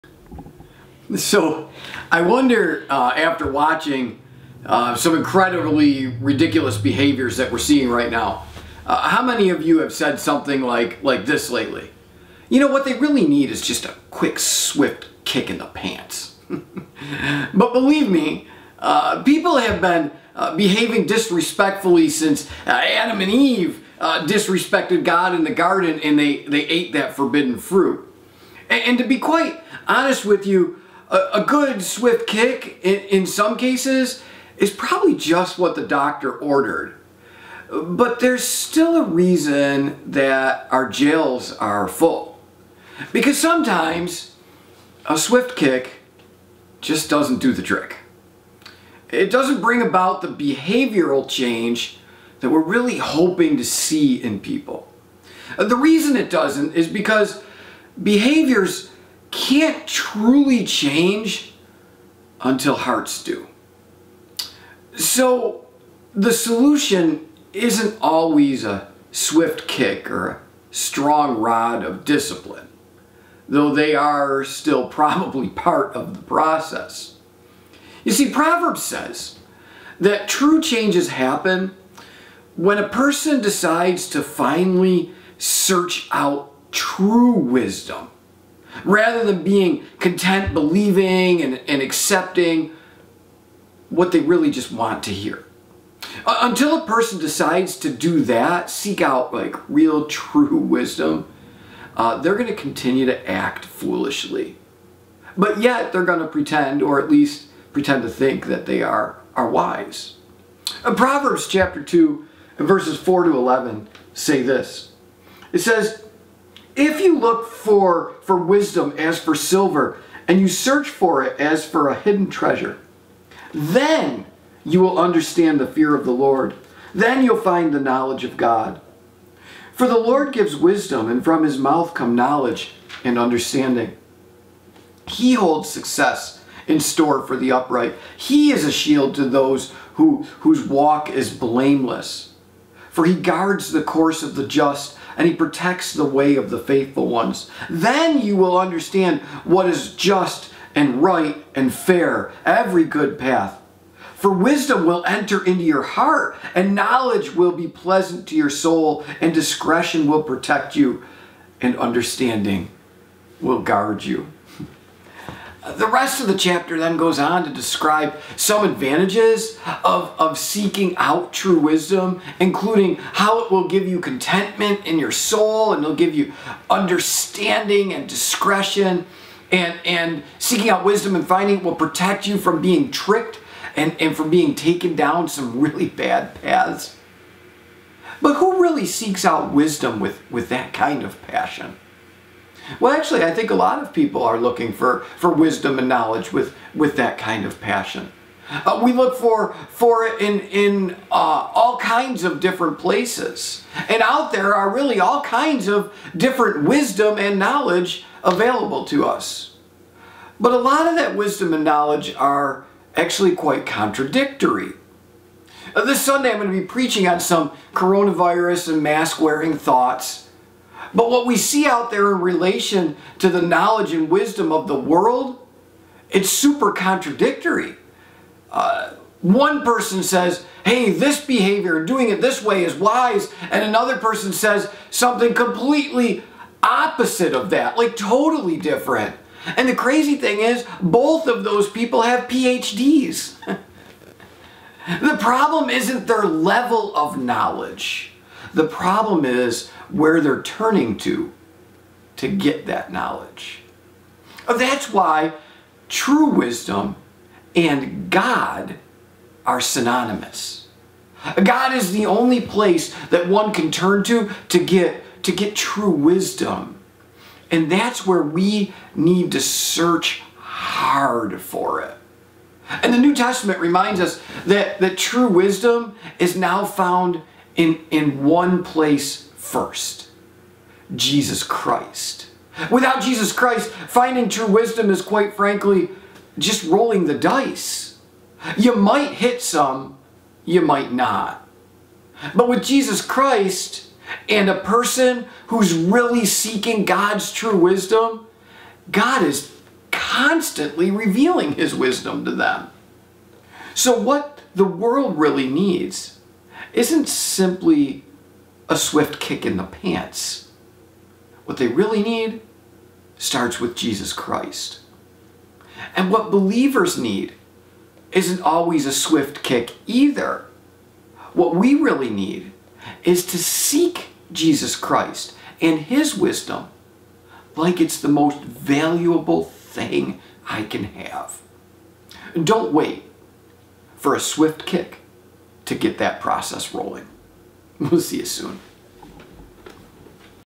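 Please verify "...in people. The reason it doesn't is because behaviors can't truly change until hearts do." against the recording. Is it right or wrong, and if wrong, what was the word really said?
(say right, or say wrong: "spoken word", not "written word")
right.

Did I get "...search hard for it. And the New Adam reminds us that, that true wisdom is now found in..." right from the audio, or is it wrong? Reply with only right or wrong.
wrong.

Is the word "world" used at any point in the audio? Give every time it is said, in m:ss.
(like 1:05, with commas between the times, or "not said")
3:44, 5:04.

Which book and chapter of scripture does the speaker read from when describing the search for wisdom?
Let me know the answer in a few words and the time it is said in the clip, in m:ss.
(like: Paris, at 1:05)
Proverbs chapter 2, at 1:50.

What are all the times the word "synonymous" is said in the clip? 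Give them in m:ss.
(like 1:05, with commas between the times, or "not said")
4:19.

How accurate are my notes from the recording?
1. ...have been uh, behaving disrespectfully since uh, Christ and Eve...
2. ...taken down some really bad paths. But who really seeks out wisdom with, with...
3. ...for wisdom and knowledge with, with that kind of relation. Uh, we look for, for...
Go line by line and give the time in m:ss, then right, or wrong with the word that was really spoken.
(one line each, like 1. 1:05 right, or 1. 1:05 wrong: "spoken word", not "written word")
1. 0:19 wrong: "Adam", not "Christ"
2. 3:04 right
3. 3:15 wrong: "passion", not "relation".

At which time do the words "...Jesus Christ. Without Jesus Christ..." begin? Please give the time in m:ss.
4:40.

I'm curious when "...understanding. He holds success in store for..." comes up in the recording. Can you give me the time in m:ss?
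2:13.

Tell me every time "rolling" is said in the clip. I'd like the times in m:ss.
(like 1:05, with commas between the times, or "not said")
4:46, 5:36.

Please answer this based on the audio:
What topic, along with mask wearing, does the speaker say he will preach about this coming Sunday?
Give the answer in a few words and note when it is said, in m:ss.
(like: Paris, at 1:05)
Coronavirus, at 3:37.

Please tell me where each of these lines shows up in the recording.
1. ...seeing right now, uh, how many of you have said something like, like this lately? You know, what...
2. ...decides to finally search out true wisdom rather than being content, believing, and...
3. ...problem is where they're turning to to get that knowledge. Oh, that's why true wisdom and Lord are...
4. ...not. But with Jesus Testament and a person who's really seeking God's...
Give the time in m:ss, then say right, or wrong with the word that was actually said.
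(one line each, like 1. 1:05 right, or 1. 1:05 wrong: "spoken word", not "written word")
1. 0:07 right
2. 1:23 right
3. 4:08 wrong: "God", not "Lord"
4. 4:50 wrong: "Christ", not "Testament".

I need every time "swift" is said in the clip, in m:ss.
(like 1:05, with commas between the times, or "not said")
0:14, 0:31, 0:45, 1:09, 5:08, 5:18, 5:34.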